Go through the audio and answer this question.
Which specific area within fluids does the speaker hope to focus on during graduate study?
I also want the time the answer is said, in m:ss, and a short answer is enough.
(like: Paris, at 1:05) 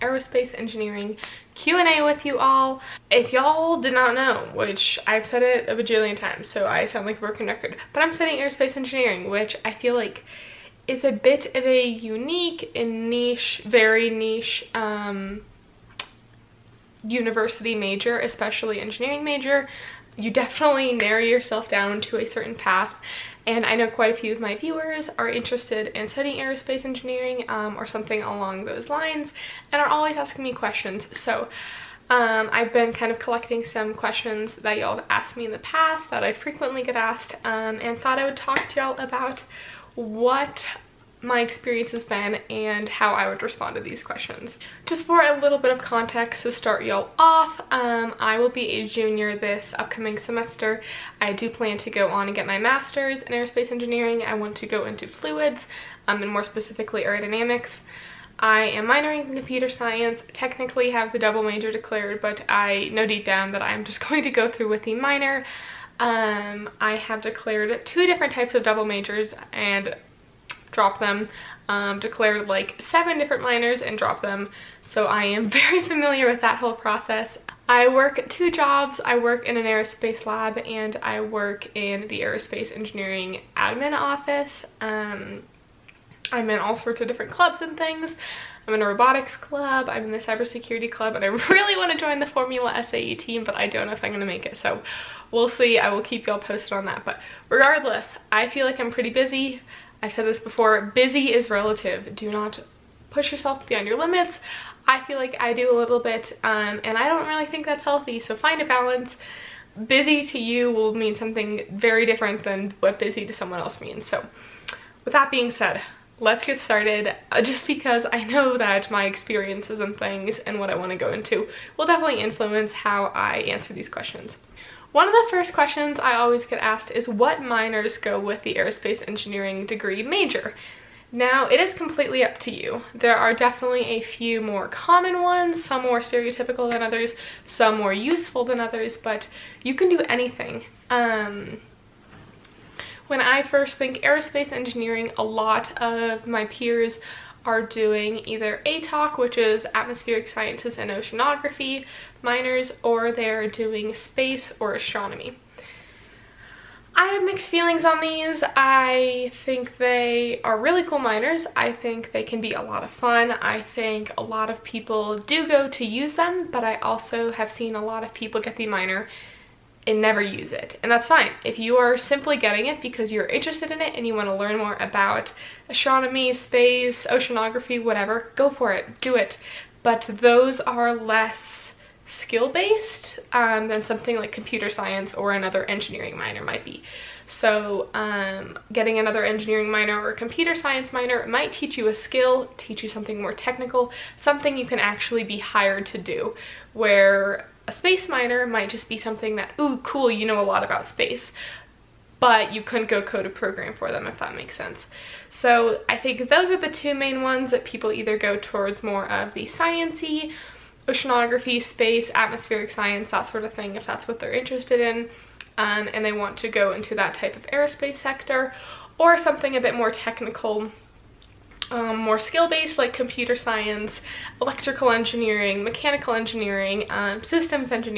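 Aerodynamics, at 0:57.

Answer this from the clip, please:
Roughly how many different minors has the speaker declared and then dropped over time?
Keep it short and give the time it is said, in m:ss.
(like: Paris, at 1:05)
7, at 1:12.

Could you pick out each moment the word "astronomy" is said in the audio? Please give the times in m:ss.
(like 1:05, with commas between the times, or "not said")
2:34, 2:55.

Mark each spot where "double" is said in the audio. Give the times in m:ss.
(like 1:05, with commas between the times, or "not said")
1:01, 1:08.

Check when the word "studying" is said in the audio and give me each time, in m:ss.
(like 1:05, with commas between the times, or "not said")
0:08, 0:26.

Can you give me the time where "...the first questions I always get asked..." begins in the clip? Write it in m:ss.
2:05.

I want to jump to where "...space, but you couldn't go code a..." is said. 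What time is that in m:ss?
3:20.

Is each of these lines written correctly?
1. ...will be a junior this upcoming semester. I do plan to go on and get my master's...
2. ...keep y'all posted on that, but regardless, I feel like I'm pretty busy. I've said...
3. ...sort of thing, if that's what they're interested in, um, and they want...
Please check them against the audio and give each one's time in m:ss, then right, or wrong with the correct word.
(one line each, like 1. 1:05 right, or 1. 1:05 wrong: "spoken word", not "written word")
1. 0:48 right
2. 1:36 right
3. 3:33 right.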